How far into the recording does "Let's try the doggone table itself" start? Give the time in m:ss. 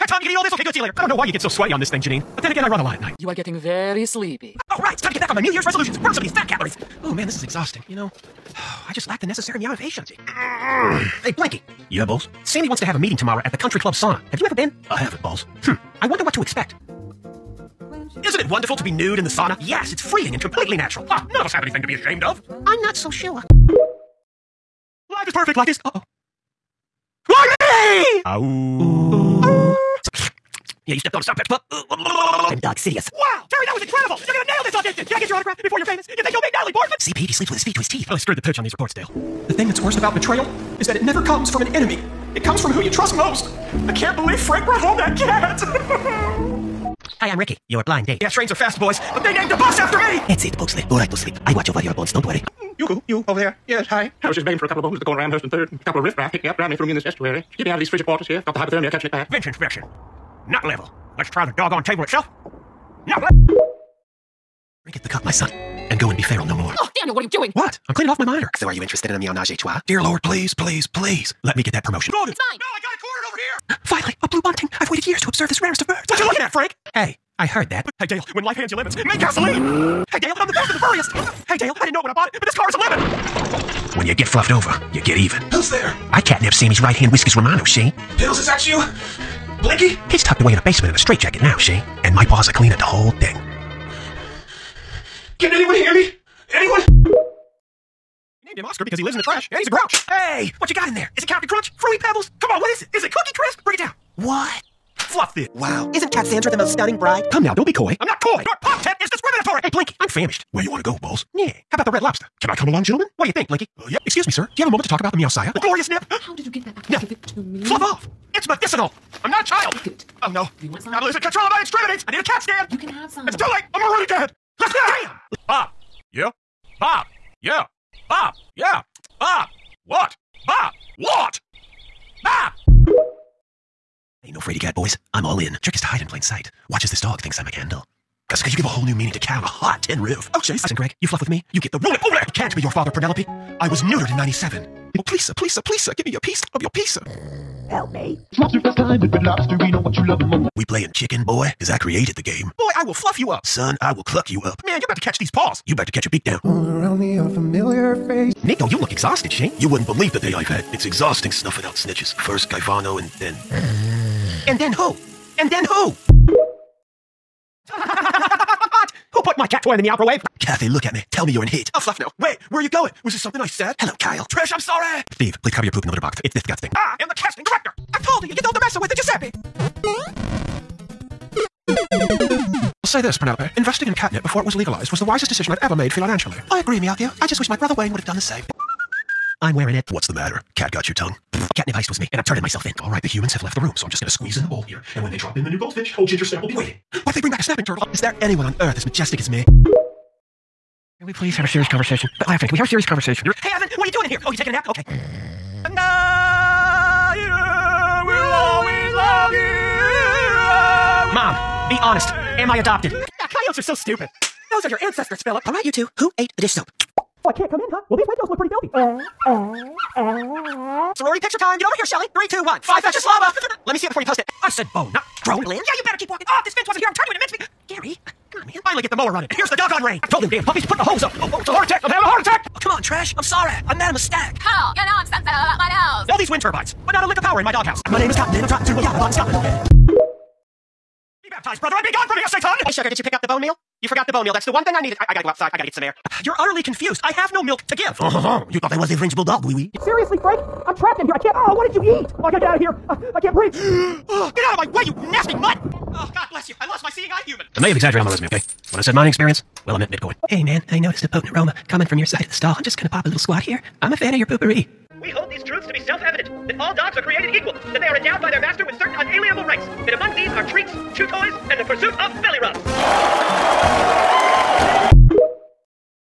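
1:01.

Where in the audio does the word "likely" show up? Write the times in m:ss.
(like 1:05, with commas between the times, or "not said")
not said.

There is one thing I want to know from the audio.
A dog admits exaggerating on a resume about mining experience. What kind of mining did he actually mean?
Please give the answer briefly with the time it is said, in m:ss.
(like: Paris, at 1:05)
Bitcoin, at 4:19.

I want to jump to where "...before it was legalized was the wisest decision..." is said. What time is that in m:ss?
3:04.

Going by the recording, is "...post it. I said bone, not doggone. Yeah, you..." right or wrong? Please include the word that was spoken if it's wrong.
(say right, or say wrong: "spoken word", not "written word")
wrong: "drone", not "doggone".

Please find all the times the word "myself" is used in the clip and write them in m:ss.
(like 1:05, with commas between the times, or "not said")
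3:12.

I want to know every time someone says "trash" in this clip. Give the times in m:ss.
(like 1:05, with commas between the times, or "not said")
1:39, 3:52.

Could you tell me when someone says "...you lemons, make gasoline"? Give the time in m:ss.
1:18.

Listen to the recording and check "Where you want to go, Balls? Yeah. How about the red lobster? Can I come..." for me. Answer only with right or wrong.
right.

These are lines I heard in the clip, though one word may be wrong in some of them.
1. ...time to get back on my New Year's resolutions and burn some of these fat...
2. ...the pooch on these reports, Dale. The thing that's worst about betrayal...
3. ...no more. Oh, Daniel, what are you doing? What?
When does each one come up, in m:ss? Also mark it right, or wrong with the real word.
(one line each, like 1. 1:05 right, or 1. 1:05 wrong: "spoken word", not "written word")
1. 0:05 right
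2. 0:38 right
3. 1:06 right.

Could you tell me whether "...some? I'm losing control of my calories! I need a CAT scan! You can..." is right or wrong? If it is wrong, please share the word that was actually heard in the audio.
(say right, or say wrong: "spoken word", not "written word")
wrong: "extremities", not "calories".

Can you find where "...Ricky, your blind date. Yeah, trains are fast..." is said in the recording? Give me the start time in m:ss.
0:47.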